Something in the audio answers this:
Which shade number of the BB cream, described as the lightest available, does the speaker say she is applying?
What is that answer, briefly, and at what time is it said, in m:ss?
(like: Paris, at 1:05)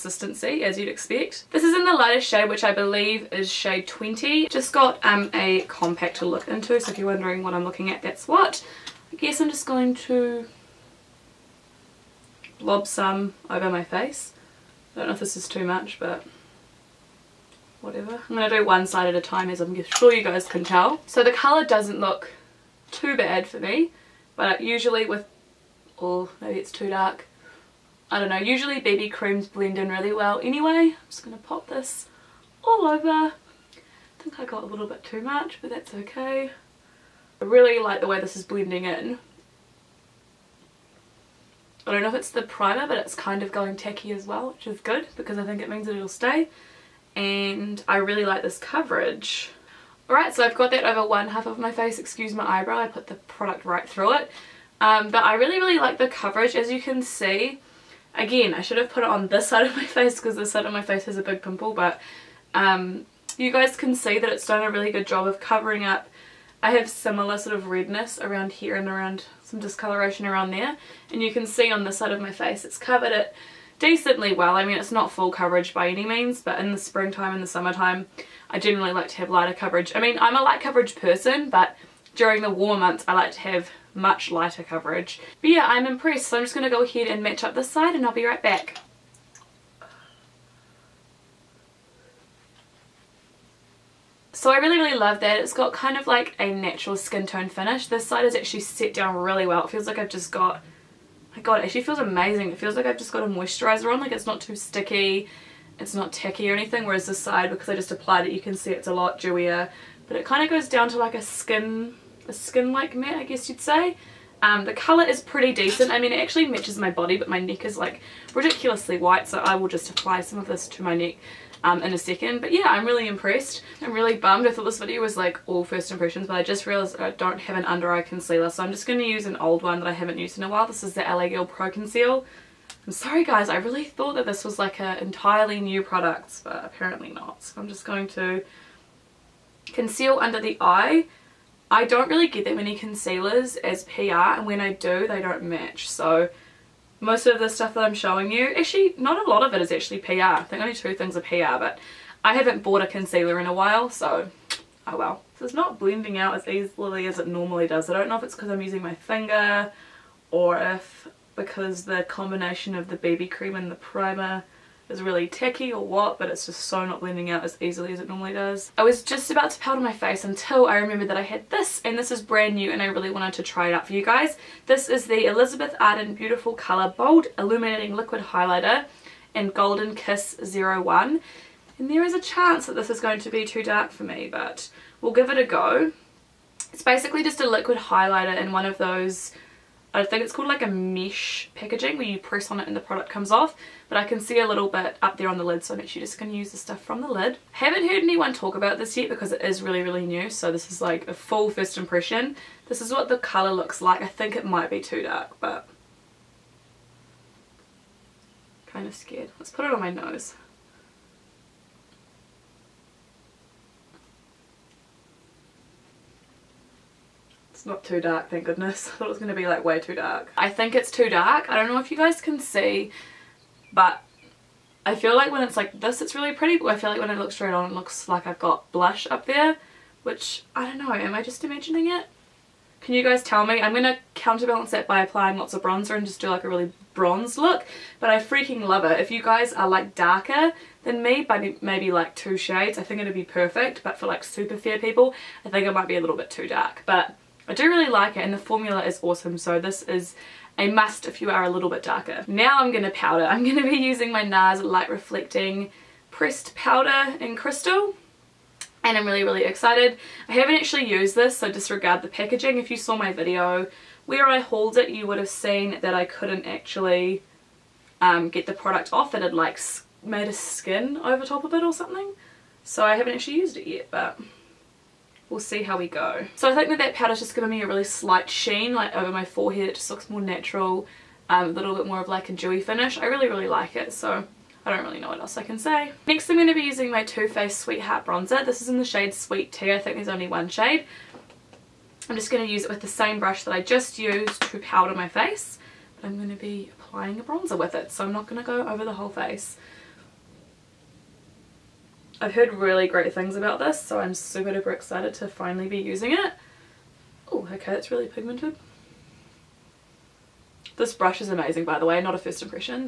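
20, at 0:03.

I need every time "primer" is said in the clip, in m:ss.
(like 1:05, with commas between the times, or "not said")
0:42, 2:43.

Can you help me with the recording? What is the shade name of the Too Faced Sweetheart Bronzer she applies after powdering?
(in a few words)
Sweet Tea.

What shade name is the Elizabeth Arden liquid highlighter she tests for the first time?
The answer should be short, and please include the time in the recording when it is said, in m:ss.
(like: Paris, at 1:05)
Golden Kiss 01, at 2:59.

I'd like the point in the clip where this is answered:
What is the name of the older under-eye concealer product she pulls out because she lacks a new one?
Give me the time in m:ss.
2:11.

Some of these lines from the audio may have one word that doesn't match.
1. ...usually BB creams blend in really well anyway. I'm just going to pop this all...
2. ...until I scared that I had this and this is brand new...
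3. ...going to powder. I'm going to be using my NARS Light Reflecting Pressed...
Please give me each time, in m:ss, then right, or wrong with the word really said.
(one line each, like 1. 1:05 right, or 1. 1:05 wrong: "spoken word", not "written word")
1. 0:28 right
2. 2:50 wrong: "remembered", not "scared"
3. 4:12 right.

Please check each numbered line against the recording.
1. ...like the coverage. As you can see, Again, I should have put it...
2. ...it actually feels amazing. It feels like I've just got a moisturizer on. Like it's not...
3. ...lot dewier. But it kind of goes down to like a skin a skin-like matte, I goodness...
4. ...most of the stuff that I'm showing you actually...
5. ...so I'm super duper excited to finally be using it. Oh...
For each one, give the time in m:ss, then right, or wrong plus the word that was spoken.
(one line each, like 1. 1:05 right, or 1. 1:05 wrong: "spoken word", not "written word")
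1. 0:55 right
2. 1:41 right
3. 1:48 wrong: "guess", not "goodness"
4. 2:26 right
5. 5:03 right.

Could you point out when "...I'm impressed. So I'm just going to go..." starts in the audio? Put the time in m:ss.
1:25.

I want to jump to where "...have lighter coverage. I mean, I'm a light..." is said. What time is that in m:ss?
1:19.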